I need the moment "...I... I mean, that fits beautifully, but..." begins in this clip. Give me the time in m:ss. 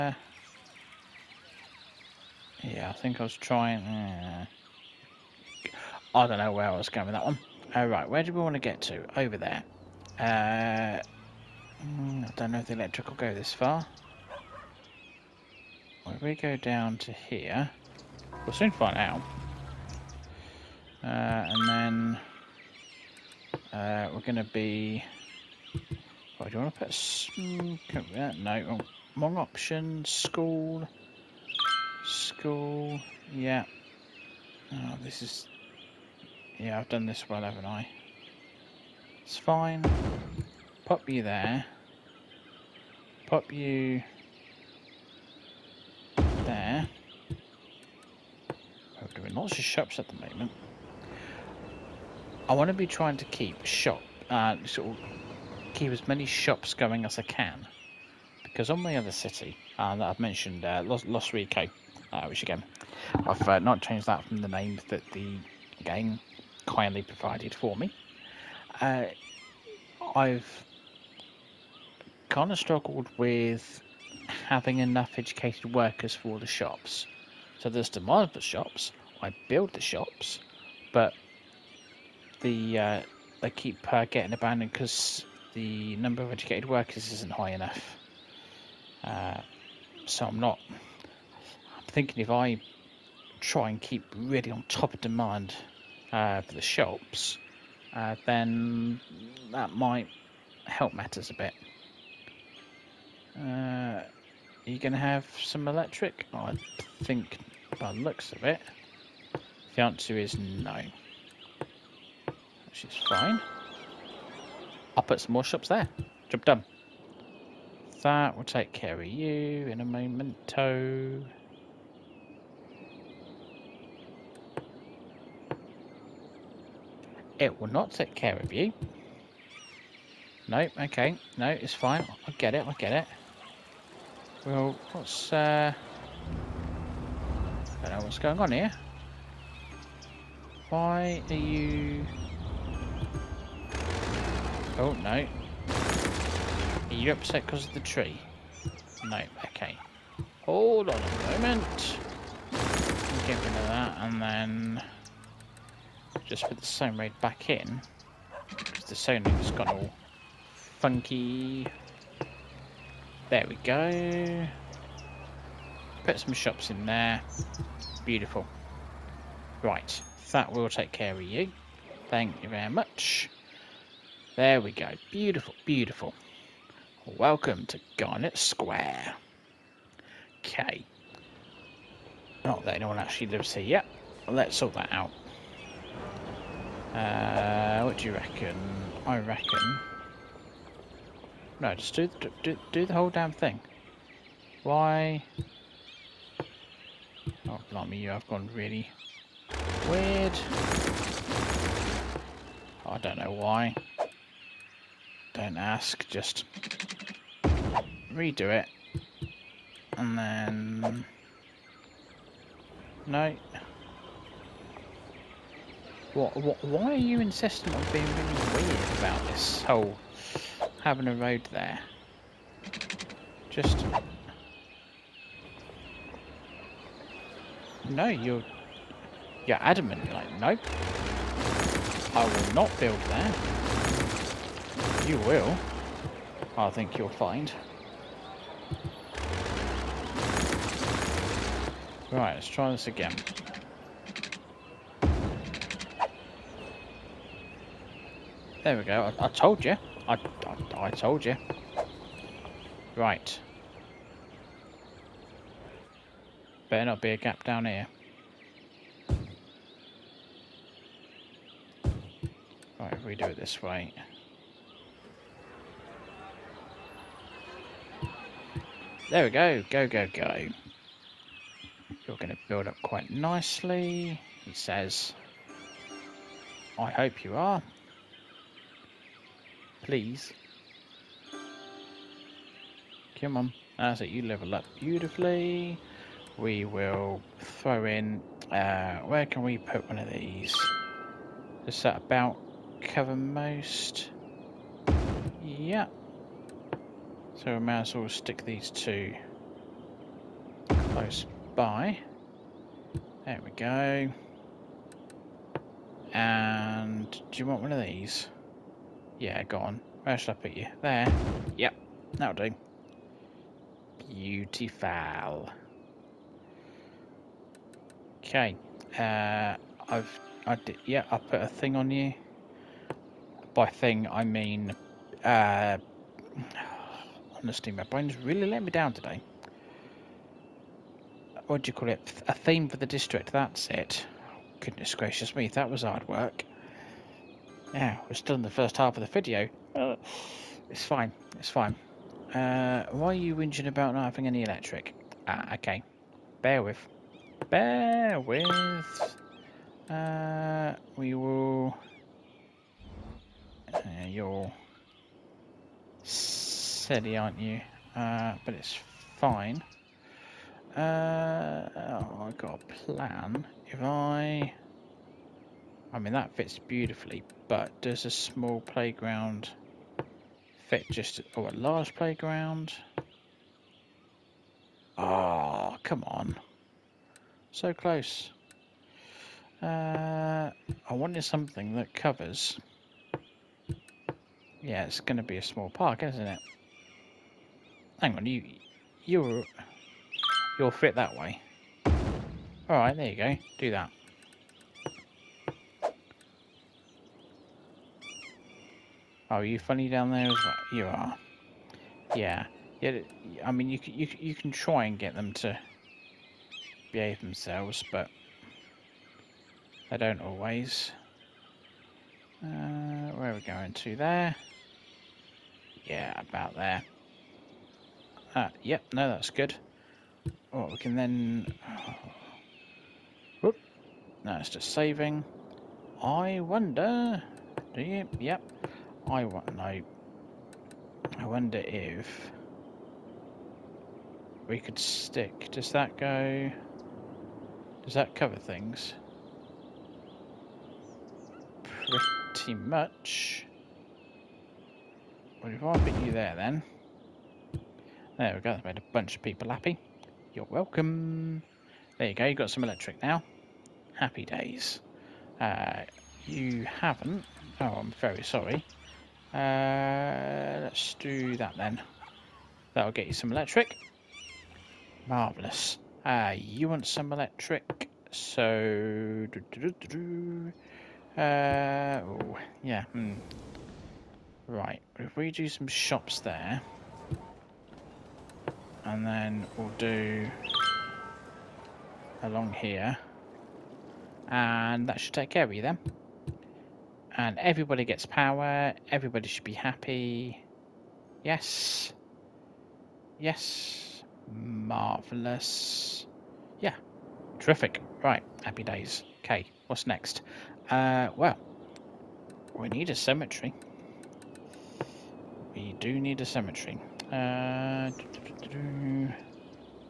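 6:03.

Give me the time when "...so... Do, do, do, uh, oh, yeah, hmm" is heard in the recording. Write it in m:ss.
7:48.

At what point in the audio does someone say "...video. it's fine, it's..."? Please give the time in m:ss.
5:39.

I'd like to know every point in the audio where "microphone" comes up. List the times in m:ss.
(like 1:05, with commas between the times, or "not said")
not said.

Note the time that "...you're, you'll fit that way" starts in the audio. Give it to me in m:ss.
6:29.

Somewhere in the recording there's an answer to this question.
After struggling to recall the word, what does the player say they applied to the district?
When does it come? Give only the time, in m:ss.
5:32.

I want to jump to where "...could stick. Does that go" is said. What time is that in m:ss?
7:14.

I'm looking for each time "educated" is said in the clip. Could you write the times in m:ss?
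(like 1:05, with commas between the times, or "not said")
1:15, 1:26.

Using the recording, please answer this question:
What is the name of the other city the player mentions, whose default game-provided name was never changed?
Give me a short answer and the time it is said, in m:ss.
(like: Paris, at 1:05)
Los Rico, at 1:01.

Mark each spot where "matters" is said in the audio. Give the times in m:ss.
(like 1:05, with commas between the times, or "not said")
1:40.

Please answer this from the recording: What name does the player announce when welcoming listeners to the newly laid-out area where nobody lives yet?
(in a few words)
Garnet Square.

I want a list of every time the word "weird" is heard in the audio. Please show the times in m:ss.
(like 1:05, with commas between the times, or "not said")
3:19, 3:38.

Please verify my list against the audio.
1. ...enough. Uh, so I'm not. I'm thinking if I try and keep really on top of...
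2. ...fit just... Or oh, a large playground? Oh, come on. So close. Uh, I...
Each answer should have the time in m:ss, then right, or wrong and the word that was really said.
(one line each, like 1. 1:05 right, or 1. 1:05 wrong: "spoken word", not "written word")
1. 1:27 right
2. 6:10 right.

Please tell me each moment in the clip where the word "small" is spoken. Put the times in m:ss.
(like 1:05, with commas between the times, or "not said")
6:08, 6:25.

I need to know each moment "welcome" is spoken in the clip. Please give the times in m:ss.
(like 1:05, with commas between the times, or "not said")
2:57, 7:30.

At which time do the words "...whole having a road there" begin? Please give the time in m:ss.
3:39.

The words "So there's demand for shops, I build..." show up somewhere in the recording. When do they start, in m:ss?
1:17.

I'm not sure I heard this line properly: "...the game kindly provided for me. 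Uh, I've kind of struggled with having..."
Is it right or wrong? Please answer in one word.
right.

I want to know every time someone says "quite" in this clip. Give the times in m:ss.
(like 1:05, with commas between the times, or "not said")
4:32.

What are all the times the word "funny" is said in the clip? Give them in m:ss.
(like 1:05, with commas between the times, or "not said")
6:39.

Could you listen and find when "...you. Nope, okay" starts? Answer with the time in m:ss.
2:08.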